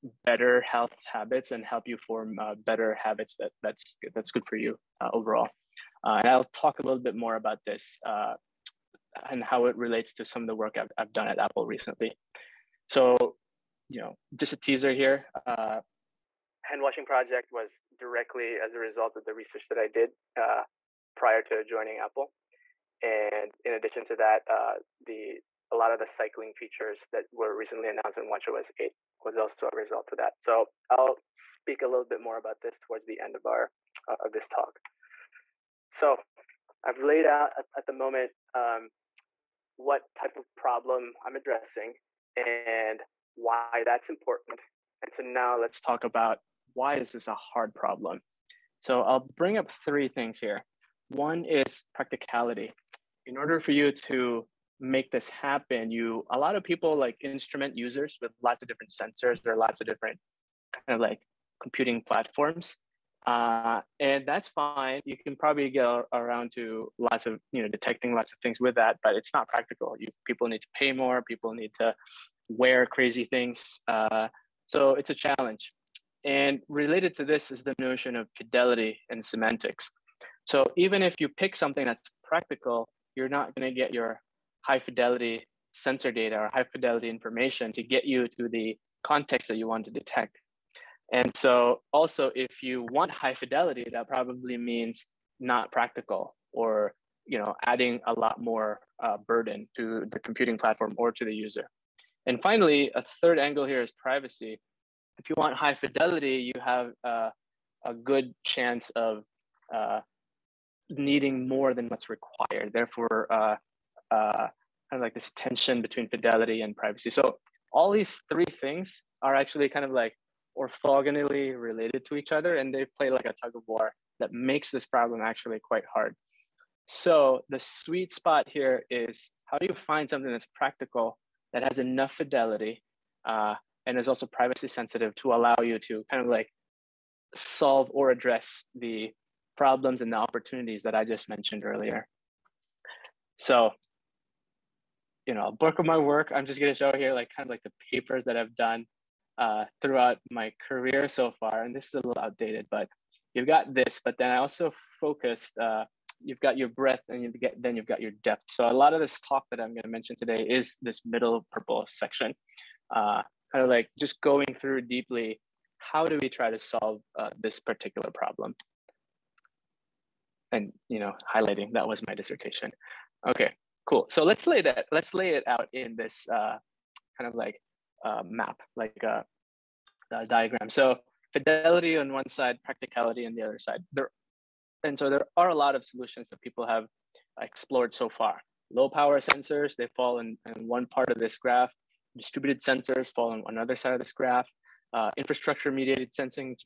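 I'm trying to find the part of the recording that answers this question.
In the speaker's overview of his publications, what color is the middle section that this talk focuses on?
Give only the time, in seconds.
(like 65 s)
161 s.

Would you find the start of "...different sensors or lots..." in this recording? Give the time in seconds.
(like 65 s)
58 s.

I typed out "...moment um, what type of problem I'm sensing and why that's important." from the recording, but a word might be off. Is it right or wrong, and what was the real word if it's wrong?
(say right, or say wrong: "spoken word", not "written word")
wrong: "addressing", not "sensing".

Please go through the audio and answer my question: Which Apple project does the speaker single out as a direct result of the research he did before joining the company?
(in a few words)
Hand washing.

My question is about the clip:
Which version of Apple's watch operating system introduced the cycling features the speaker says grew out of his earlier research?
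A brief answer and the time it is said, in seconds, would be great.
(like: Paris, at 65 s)
WatchOS 8, at 28 s.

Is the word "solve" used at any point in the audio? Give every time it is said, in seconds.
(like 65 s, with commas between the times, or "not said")
137 s, 166 s.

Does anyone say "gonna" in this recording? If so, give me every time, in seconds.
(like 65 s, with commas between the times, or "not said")
146 s, 159 s.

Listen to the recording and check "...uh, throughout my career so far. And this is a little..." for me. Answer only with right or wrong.
right.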